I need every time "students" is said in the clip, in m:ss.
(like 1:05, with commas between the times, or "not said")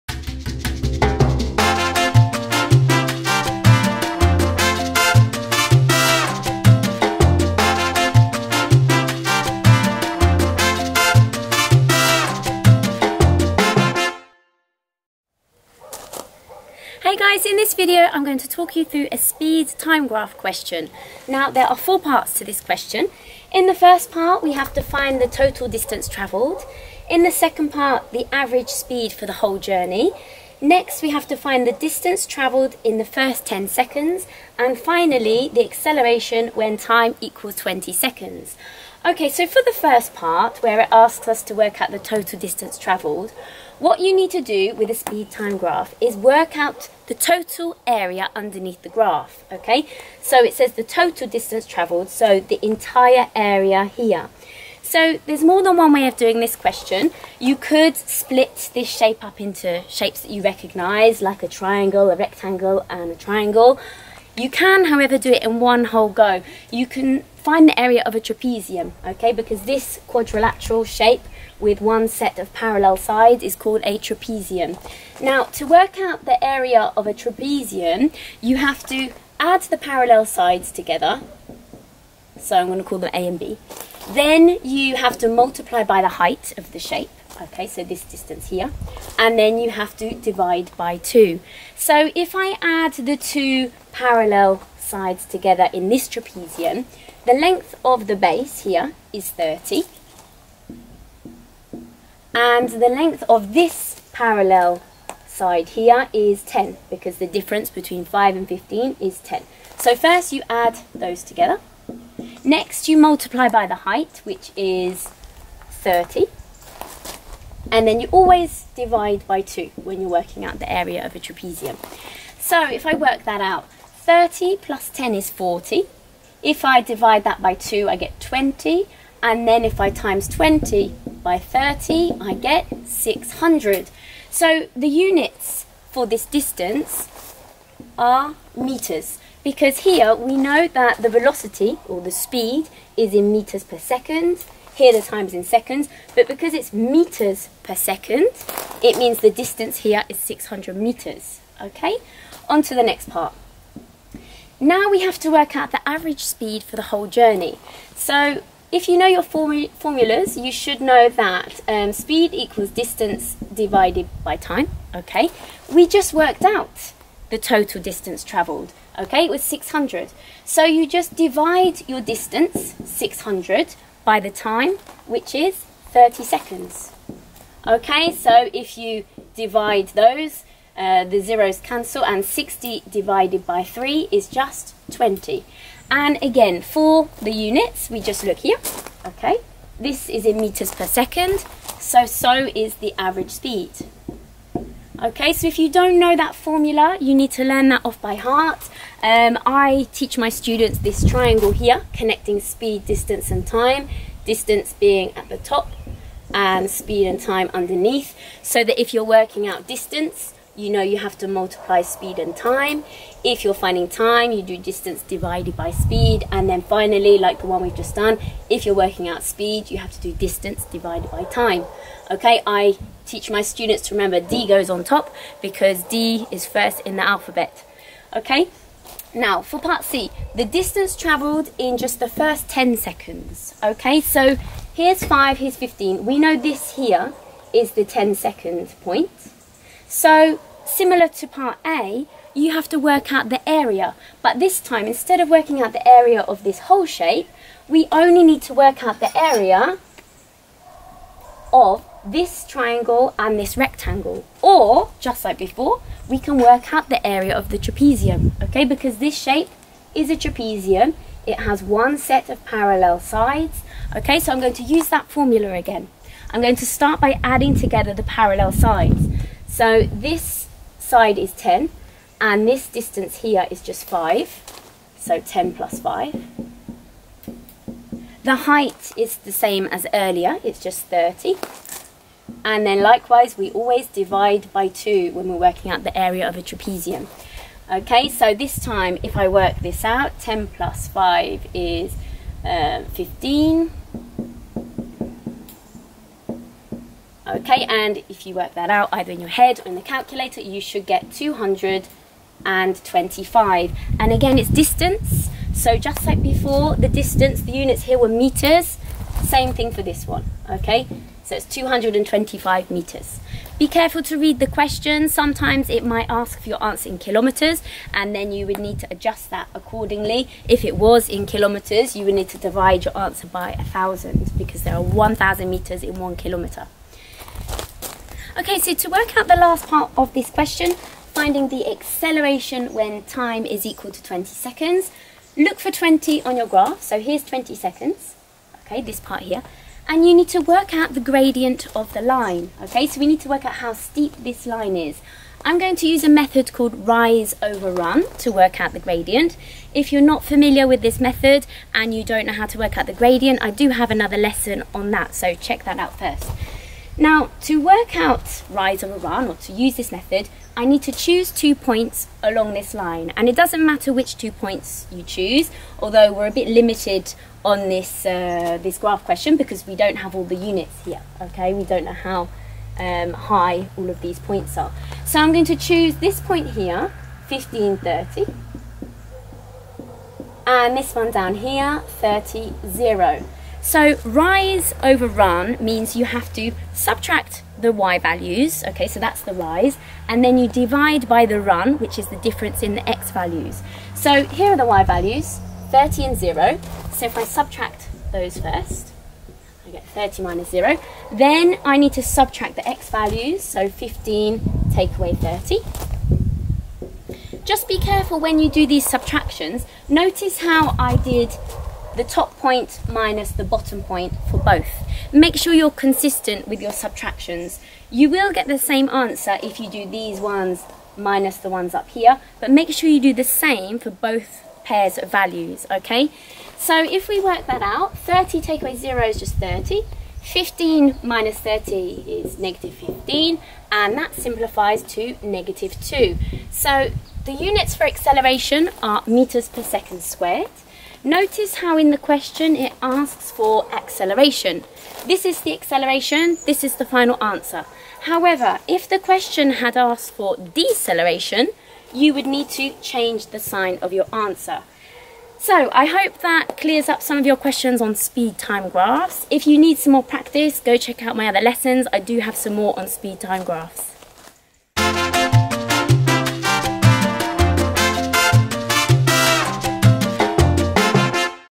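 3:20, 3:43.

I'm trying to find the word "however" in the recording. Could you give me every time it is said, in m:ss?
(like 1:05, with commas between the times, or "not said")
1:04, 7:28.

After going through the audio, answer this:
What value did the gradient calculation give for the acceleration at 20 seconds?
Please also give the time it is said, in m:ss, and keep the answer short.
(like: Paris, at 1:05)
-2, at 7:15.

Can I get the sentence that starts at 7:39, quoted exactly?
If you need some more practice, go check out my other lessons.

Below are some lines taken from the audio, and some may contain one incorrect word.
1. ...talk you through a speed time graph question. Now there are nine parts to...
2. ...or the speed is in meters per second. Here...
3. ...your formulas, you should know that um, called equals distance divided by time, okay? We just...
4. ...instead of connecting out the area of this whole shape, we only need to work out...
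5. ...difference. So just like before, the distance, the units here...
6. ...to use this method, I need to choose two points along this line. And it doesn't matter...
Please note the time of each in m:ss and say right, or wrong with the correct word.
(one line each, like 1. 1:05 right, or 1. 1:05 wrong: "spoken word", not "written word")
1. 0:18 wrong: "four", not "nine"
2. 2:21 right
3. 2:39 wrong: "speed", not "called"
4. 4:04 wrong: "working", not "connecting"
5. 5:04 wrong: "distance", not "difference"
6. 5:59 right.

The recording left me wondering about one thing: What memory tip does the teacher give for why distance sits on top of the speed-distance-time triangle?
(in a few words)
first in the alphabet.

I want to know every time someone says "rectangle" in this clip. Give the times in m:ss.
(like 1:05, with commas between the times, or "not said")
1:02, 4:13.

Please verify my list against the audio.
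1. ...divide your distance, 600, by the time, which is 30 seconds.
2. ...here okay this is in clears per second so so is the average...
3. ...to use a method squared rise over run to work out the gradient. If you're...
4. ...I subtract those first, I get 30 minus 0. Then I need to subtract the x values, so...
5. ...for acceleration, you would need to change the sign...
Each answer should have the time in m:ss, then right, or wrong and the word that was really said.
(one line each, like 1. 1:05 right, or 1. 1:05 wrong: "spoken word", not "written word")
1. 2:51 right
2. 3:08 wrong: "meters", not "clears"
3. 5:45 wrong: "called", not "squared"
4. 6:37 right
5. 7:30 wrong: "deceleration", not "acceleration".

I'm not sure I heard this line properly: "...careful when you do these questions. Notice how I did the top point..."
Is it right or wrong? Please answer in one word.
wrong.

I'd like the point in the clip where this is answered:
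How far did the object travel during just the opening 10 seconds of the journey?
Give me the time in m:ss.
5:11.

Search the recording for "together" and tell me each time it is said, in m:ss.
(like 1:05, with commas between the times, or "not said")
1:20, 1:35, 1:51, 4:27.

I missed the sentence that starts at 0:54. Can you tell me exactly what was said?
So there's more than one way of doing this question.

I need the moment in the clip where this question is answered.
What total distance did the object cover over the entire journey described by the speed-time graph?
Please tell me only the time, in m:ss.
2:30.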